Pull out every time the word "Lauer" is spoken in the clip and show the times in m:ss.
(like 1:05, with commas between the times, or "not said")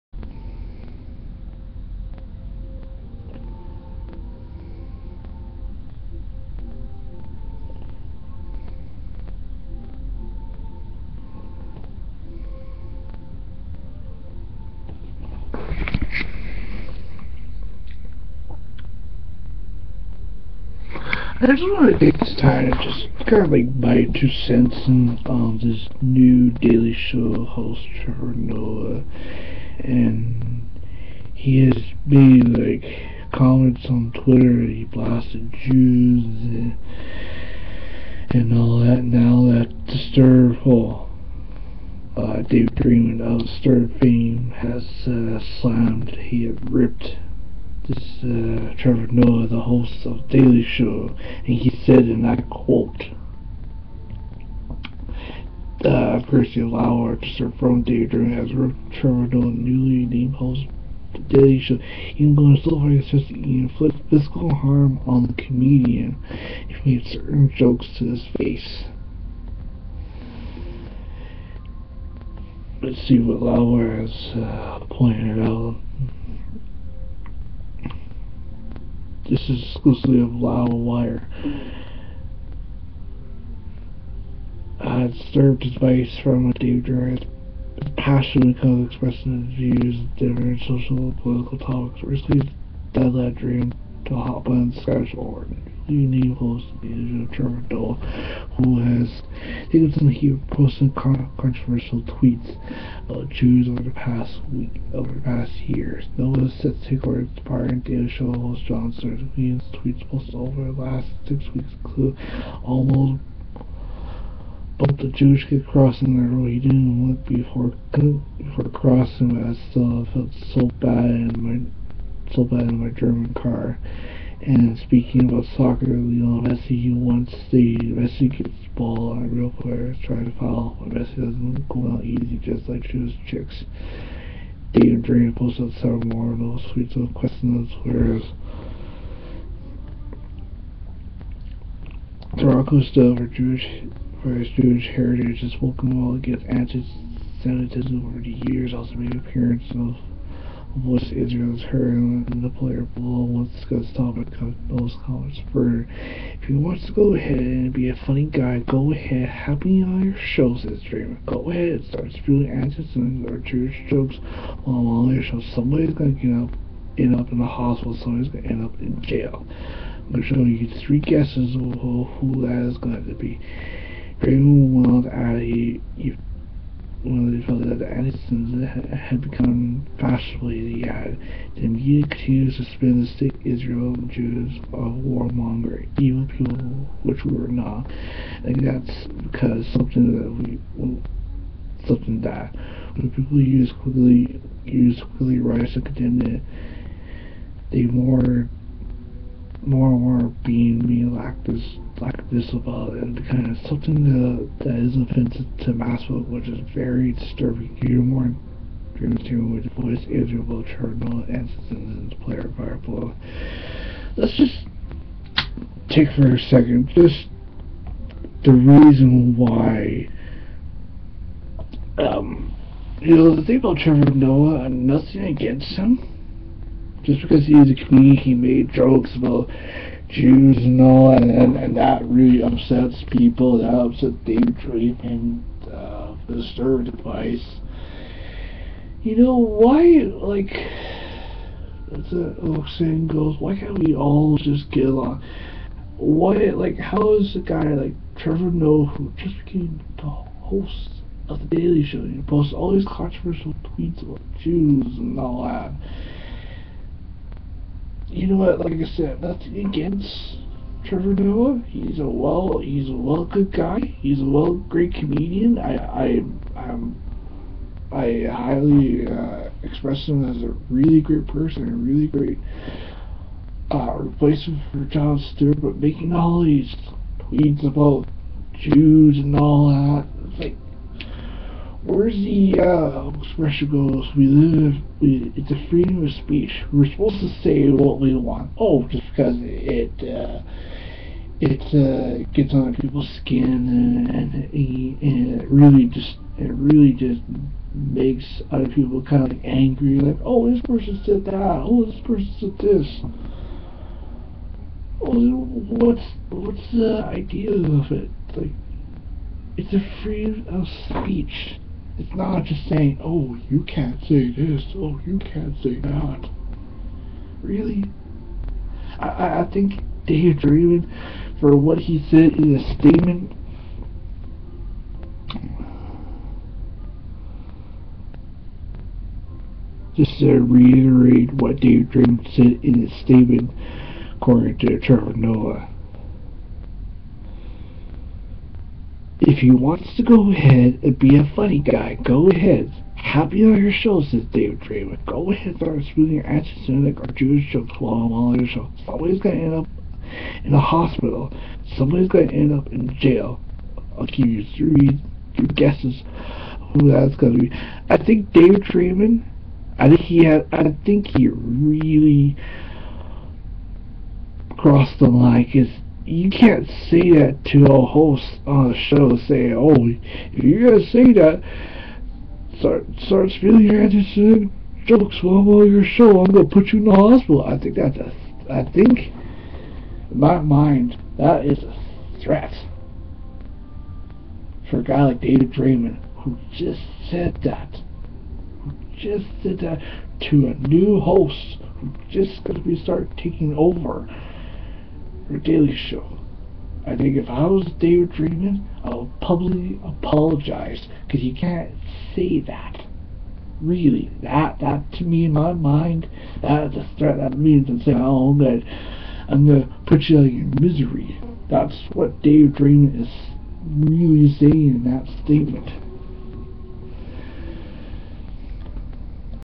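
0:56, 1:13.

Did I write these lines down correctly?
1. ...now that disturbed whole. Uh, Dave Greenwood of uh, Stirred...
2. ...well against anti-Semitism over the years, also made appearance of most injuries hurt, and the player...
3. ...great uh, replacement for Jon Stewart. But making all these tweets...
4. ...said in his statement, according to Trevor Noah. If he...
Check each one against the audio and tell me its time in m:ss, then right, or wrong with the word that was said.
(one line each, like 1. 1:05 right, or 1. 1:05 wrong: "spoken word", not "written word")
1. 0:39 right
2. 2:26 right
3. 4:32 right
4. 5:32 right.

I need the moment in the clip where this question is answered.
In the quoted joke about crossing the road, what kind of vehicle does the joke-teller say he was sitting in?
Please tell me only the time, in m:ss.
2:02.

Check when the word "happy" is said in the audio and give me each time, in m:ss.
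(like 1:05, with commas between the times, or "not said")
2:39, 5:42.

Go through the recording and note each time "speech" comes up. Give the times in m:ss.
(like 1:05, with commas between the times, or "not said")
4:46, 5:10.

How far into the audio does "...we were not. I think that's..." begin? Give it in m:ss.
3:07.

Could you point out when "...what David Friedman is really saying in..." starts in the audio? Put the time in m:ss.
6:51.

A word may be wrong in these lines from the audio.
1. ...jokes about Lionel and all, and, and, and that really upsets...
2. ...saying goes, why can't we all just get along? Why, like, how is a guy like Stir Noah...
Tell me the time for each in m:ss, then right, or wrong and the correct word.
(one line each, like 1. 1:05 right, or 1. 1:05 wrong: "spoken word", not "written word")
1. 3:48 wrong: "Jews", not "Lionel"
2. 4:02 wrong: "Trevor", not "Stir".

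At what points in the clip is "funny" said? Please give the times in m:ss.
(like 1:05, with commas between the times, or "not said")
2:37, 5:41.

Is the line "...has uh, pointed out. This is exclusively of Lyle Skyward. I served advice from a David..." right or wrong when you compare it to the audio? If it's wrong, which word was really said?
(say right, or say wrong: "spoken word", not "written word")
wrong: "Wire", not "Skyward".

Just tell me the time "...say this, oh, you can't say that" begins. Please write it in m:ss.
5:14.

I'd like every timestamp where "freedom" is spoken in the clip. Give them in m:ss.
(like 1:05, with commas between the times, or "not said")
4:45, 5:10.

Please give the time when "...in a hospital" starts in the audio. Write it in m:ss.
5:50.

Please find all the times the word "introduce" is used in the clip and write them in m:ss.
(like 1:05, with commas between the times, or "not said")
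not said.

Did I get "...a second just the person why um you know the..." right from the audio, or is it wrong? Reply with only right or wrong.
wrong.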